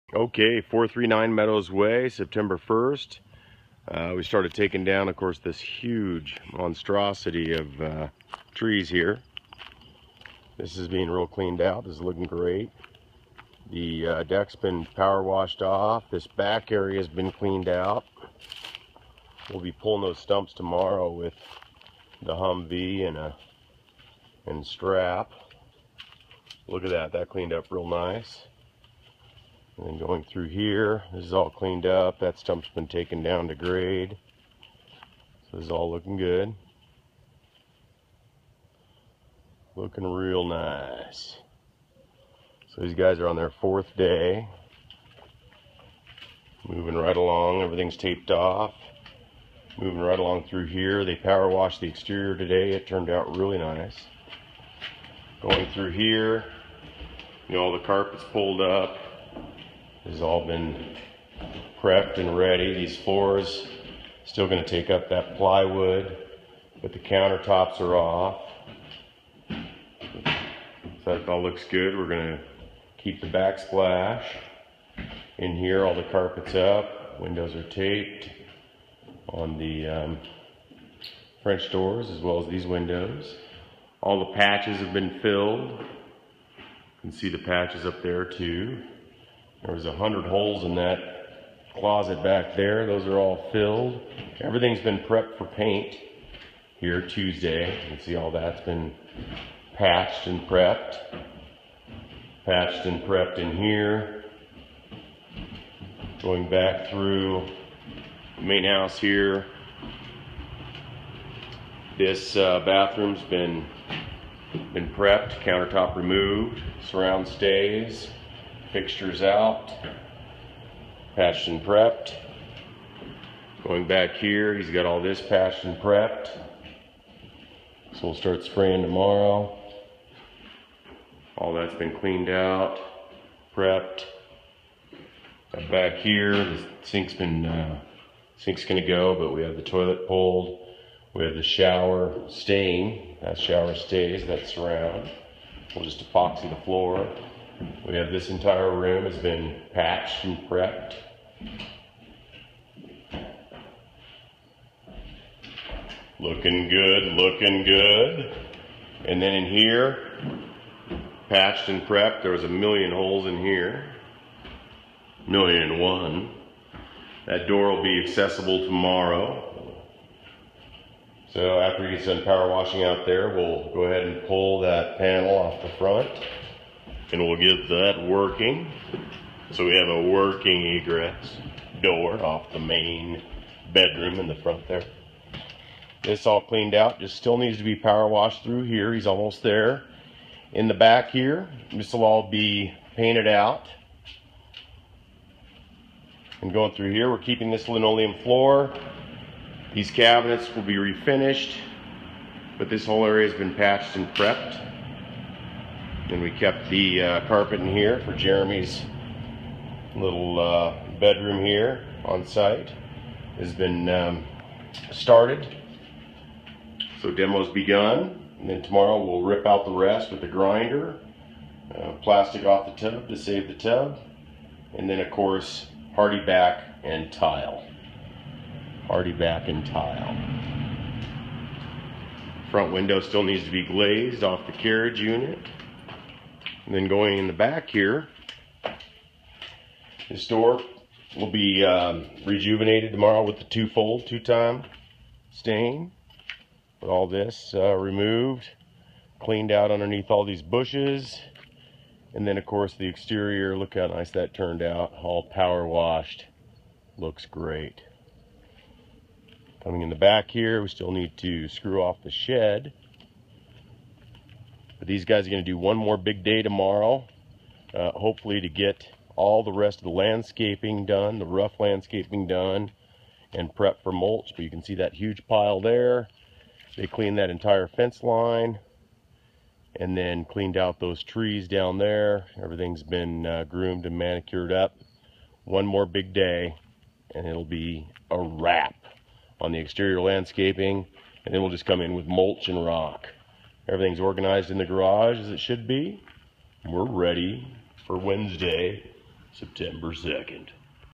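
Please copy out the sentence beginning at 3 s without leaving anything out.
Uh, we started taking down, of course, this huge monstrosity of uh, trees here.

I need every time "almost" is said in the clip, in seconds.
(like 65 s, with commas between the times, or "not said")
189 s.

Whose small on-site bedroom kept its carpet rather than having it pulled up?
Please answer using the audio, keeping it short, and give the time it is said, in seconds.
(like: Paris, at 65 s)
Jeremy, at 208 s.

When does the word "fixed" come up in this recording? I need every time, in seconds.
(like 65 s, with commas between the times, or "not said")
not said.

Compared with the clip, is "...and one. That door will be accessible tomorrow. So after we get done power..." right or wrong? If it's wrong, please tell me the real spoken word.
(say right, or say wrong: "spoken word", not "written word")
right.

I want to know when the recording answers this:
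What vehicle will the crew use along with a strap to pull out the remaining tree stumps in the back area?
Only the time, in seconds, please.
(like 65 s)
22 s.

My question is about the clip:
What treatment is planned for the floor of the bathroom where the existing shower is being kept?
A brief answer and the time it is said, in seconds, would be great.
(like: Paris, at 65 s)
Epoxy, at 146 s.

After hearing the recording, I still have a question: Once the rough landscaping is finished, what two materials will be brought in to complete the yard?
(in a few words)
Mulch and rock.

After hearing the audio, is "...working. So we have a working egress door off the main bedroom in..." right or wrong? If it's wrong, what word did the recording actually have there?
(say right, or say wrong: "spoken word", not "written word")
right.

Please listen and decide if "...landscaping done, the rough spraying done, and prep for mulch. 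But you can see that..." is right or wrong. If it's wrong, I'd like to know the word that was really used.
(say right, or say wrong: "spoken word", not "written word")
wrong: "landscaping", not "spraying".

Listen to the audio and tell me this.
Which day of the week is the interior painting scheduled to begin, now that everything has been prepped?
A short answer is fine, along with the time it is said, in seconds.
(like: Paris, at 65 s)
Tuesday, at 97 s.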